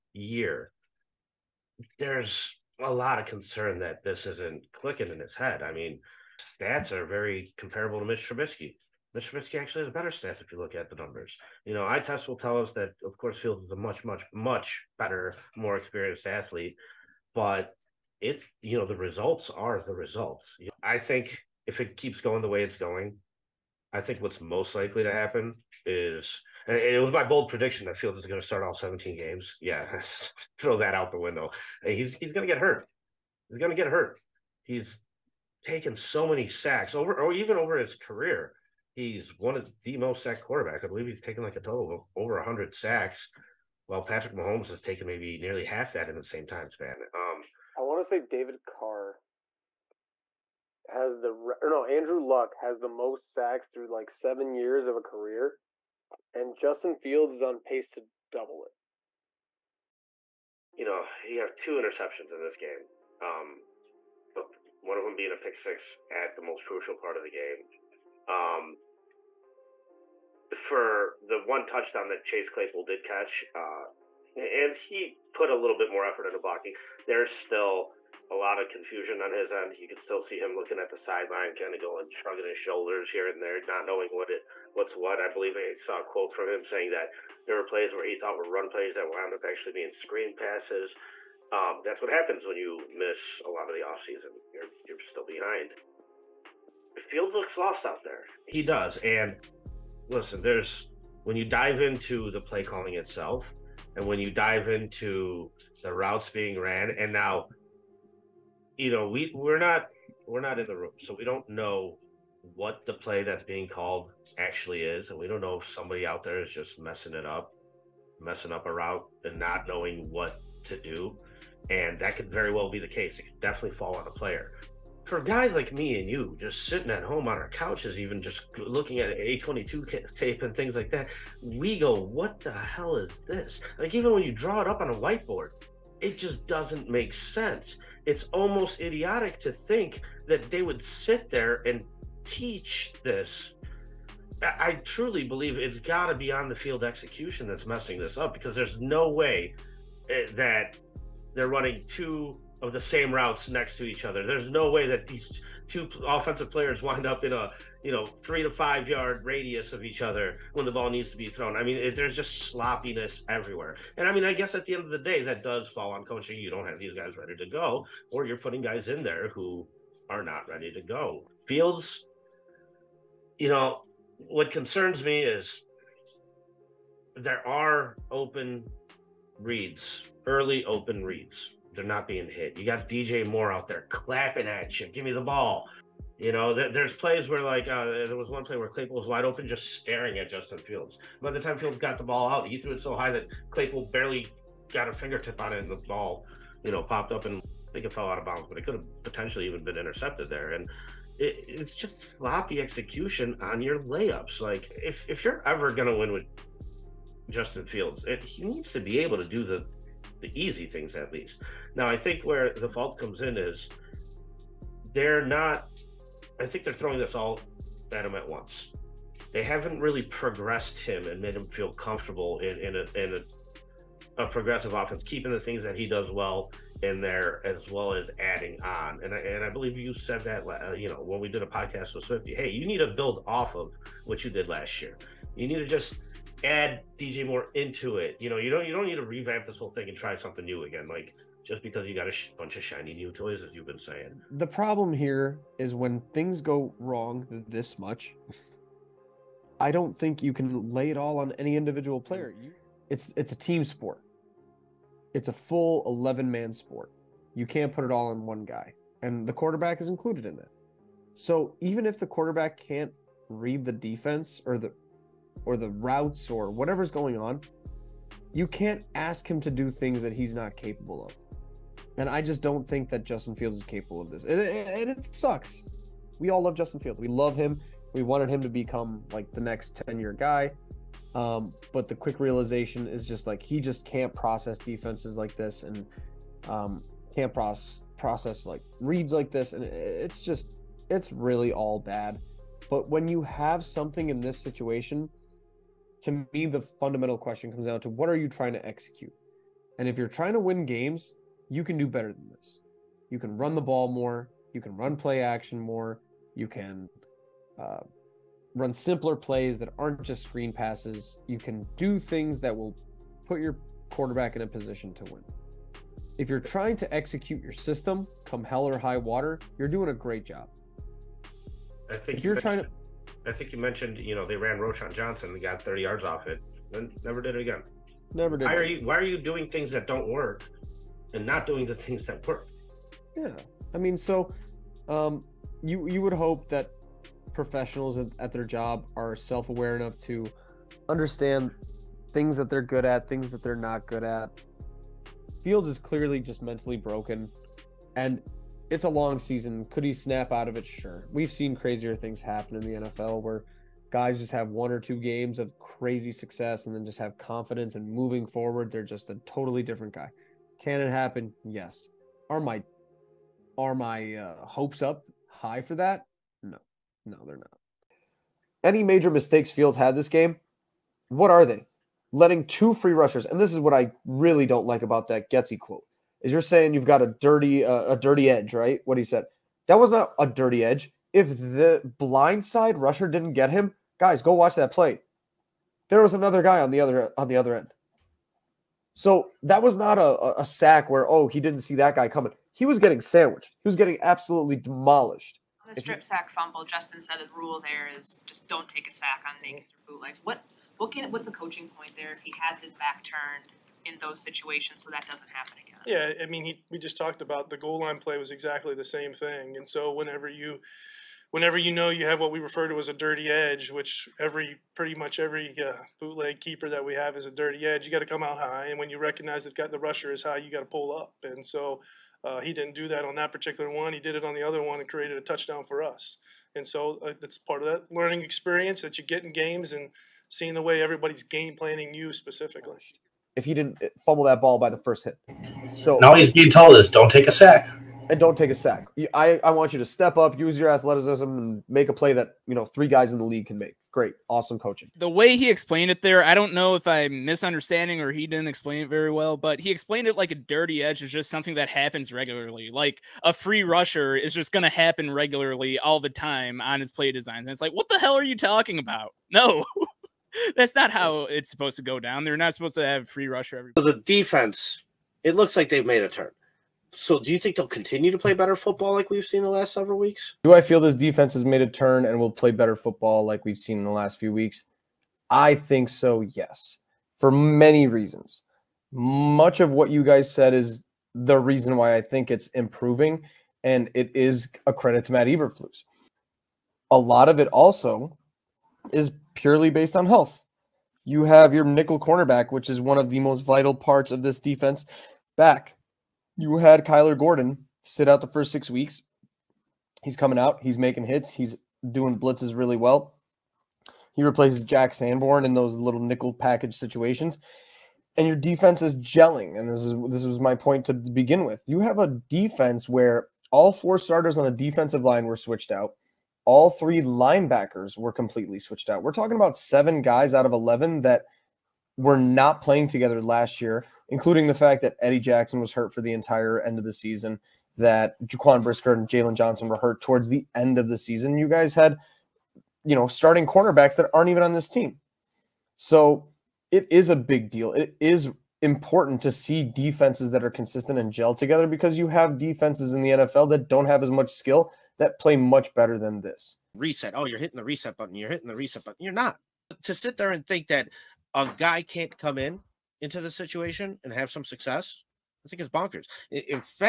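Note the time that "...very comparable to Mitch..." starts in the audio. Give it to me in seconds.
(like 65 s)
7 s.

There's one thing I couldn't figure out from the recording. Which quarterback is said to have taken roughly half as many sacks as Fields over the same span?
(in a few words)
Patrick Mahomes.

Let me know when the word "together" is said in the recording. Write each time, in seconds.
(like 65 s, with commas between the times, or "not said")
522 s, 541 s.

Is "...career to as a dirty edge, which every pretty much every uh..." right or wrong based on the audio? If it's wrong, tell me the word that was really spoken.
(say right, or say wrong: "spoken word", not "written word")
wrong: "refer", not "career".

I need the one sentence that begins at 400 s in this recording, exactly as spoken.
What what can what's the coaching point there if he has his back turned in those situations so that doesn't happen again.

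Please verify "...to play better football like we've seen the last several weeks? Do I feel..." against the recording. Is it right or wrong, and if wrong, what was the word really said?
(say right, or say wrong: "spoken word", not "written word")
right.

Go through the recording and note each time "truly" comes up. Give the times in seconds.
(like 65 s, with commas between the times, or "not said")
144 s.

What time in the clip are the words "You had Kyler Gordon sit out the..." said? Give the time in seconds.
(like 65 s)
496 s.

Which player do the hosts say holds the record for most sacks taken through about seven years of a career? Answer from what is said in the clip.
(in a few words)
Andrew Luck.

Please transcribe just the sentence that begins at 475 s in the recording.
I think so, yes, for many reasons.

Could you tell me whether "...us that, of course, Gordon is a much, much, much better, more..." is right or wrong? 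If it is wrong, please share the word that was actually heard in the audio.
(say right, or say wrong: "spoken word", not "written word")
wrong: "Fields", not "Gordon".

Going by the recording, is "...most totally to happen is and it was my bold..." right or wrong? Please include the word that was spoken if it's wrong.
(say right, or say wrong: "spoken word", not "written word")
wrong: "likely", not "totally".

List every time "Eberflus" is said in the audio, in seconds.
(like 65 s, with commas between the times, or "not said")
485 s.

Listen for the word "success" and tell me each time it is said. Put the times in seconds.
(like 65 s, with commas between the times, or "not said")
356 s, 554 s.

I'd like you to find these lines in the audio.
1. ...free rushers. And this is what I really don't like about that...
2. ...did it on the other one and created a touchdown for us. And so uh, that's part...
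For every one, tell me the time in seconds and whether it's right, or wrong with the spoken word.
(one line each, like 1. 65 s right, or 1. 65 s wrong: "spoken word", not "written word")
1. 372 s right
2. 423 s right.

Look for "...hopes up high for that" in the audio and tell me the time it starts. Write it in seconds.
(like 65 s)
364 s.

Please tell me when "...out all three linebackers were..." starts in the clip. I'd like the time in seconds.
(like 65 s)
515 s.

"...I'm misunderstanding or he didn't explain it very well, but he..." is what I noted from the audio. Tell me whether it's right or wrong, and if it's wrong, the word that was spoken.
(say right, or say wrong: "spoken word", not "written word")
right.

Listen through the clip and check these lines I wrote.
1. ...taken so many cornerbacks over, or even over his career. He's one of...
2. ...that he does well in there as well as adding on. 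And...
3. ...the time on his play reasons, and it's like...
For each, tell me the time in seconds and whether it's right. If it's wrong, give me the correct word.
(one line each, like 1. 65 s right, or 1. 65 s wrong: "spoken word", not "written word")
1. 35 s wrong: "sacks", not "cornerbacks"
2. 225 s right
3. 455 s wrong: "designs", not "reasons".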